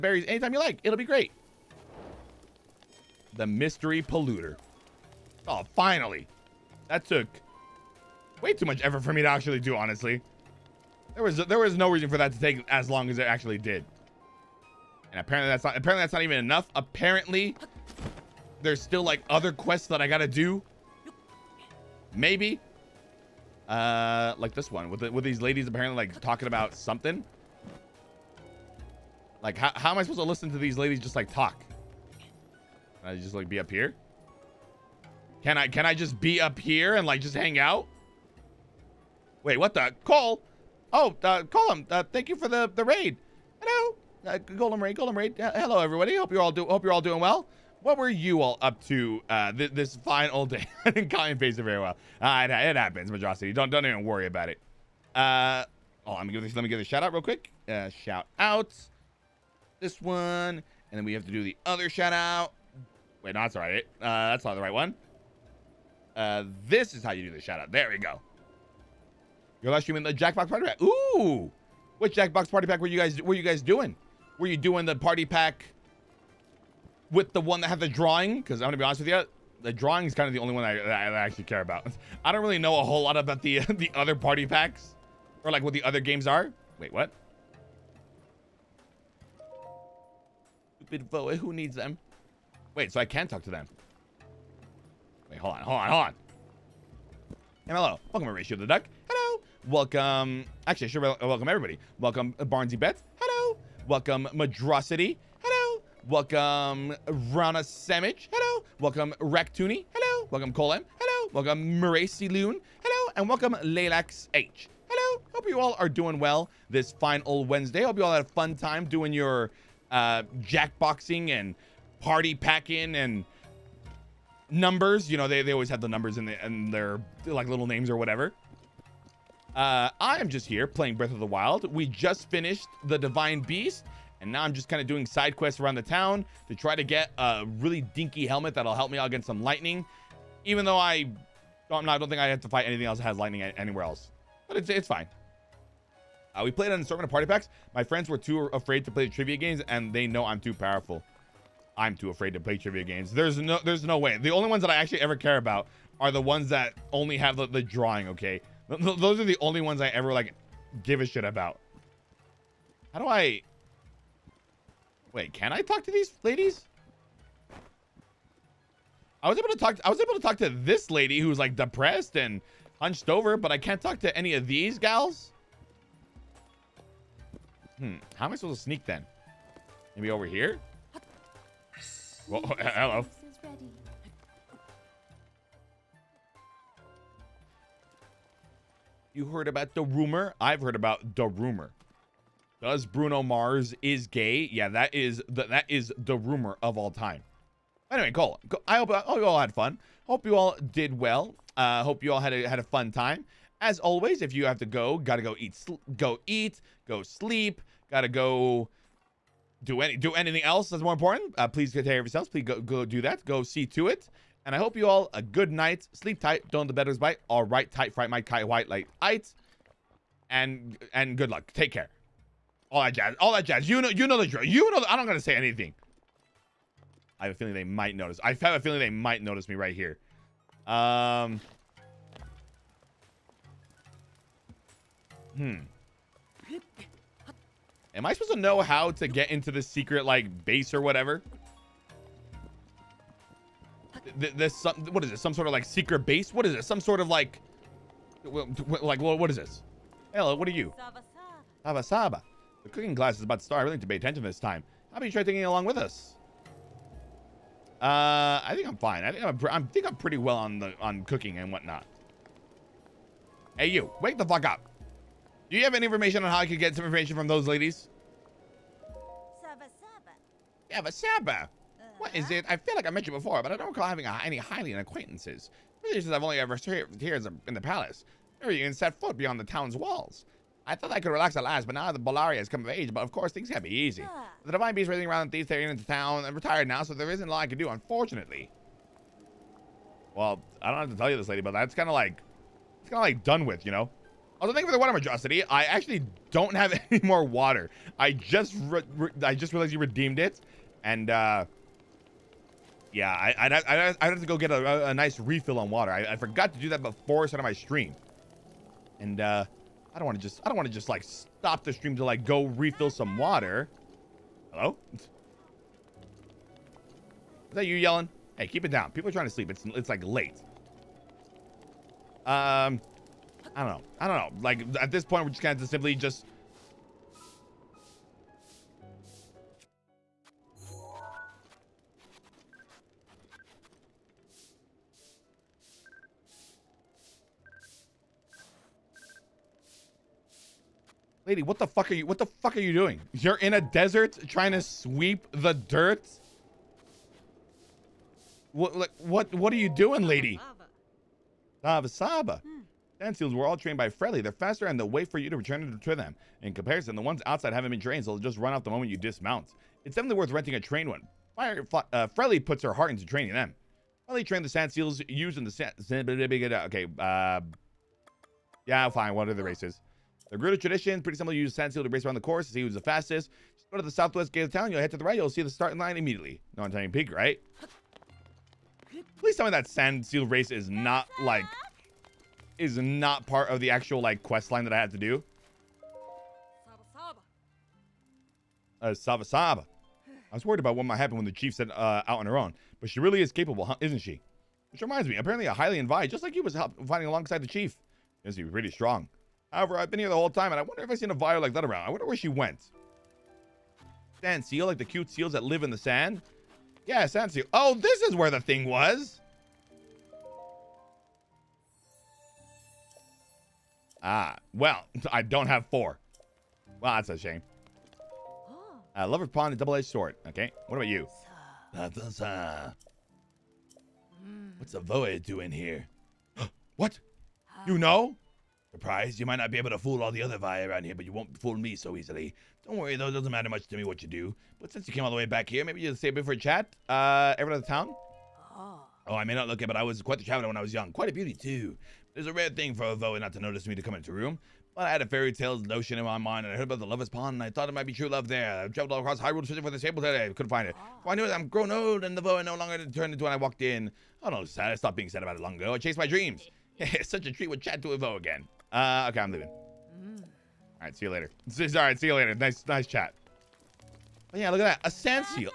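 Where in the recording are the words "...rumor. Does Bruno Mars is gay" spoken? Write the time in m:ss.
3:11.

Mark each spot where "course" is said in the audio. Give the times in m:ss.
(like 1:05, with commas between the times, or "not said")
4:43, 6:12.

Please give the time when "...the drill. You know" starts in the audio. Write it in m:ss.
3:44.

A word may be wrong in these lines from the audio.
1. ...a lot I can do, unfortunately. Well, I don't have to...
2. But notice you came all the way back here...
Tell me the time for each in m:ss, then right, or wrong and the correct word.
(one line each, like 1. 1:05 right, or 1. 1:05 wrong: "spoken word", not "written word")
1. 4:47 right
2. 7:14 wrong: "since", not "notice".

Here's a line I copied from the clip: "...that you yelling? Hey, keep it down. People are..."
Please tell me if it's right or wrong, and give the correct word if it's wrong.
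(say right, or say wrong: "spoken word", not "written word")
right.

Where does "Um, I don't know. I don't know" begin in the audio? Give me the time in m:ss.
5:22.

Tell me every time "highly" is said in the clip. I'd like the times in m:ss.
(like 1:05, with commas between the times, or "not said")
6:35.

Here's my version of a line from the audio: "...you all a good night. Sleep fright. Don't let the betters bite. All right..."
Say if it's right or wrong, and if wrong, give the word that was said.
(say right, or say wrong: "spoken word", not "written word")
wrong: "tight", not "fright".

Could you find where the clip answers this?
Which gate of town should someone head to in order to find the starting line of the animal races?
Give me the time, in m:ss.
6:13.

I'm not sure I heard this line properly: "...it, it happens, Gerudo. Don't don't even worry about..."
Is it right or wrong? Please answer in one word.
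wrong.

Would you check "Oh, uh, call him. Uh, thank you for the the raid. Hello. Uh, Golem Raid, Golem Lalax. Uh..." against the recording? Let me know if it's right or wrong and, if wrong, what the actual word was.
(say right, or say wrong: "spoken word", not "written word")
wrong: "Raid", not "Lalax".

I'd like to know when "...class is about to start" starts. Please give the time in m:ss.
4:12.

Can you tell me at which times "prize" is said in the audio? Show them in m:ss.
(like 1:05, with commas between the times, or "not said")
7:08.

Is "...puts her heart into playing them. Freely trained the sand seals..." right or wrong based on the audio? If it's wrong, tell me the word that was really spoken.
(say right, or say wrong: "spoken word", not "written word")
wrong: "training", not "playing".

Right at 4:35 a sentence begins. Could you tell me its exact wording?
Really, since I've only ever served here in the palace.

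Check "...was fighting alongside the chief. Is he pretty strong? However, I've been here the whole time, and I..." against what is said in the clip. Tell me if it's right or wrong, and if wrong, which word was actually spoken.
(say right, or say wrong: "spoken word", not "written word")
right.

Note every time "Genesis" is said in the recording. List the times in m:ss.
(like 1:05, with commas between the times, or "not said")
not said.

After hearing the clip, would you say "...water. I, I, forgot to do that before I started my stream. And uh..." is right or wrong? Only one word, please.
right.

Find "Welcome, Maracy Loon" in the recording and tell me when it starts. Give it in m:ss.
1:51.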